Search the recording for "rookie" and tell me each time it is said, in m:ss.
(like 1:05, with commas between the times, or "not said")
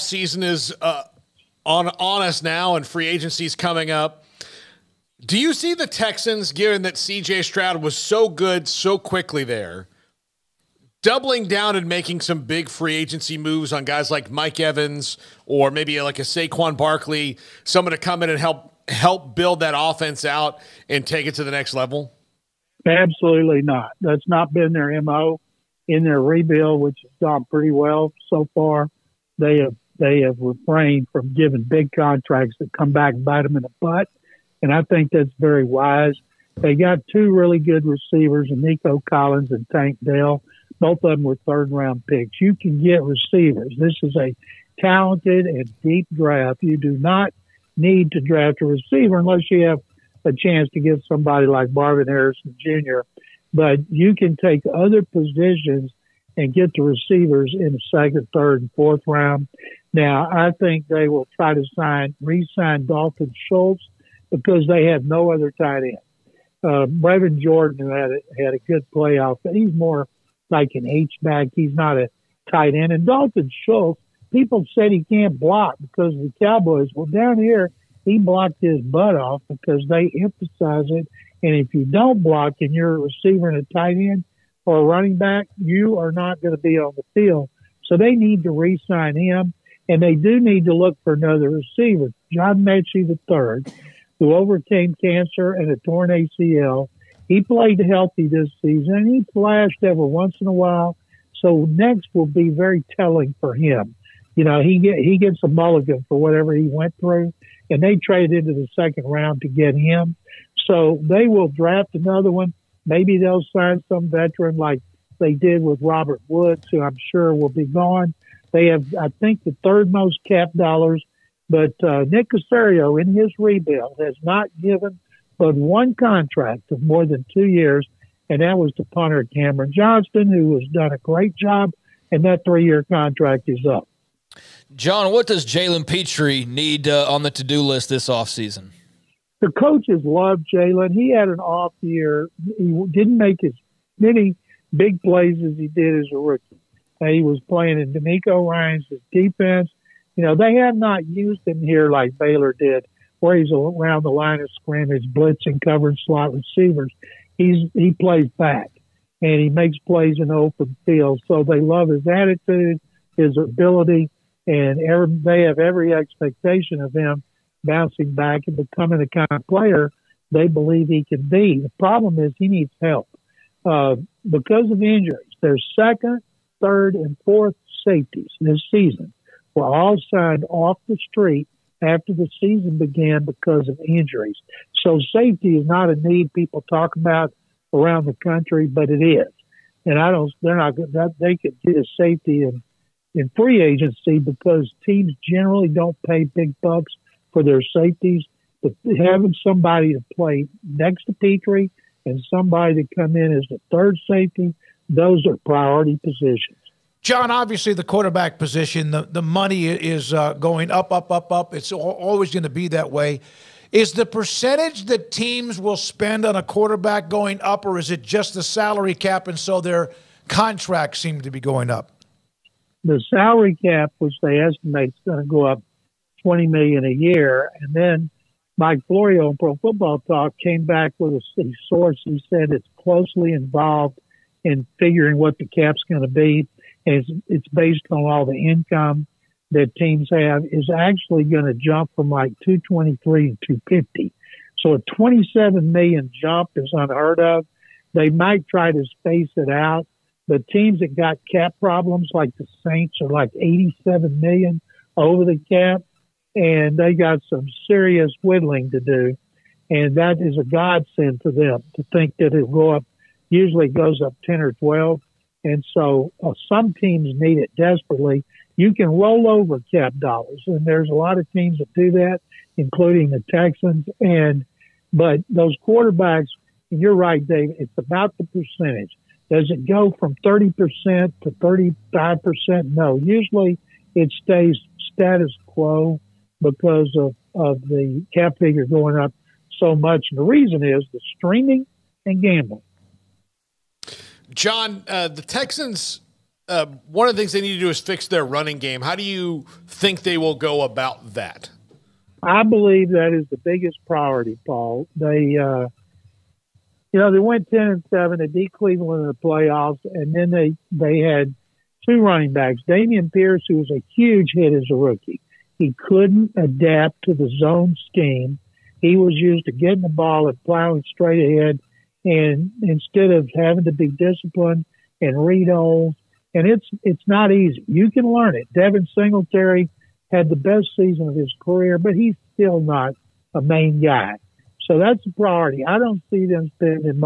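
2:26, 5:14.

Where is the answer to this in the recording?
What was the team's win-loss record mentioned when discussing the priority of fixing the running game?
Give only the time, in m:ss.
5:07.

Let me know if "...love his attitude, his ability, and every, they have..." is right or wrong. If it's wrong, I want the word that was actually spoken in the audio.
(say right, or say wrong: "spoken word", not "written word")
right.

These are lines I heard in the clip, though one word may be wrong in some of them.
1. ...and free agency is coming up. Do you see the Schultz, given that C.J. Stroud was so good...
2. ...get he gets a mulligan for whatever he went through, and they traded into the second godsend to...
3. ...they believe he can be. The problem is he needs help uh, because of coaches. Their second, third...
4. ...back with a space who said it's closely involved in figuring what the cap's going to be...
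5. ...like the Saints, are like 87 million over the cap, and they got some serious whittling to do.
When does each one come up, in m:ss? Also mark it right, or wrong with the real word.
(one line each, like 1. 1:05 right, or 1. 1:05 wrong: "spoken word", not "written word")
1. 0:02 wrong: "Texans", not "Schultz"
2. 1:44 wrong: "round", not "godsend"
3. 2:50 wrong: "injuries", not "coaches"
4. 3:50 wrong: "source", not "space"
5. 4:12 right.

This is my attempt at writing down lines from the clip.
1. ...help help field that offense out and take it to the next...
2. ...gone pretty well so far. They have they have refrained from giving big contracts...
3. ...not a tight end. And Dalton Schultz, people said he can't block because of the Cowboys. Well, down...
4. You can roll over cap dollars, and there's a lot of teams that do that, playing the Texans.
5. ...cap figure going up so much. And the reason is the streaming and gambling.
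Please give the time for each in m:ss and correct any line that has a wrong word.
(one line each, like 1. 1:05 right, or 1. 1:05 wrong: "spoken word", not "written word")
1. 0:18 wrong: "build", not "field"
2. 0:27 right
3. 1:11 right
4. 4:28 wrong: "including", not "playing"
5. 4:48 right.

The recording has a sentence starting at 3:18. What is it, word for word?
But having somebody to play next to Pitre and somebody to come in as the third safety, those are priority positions.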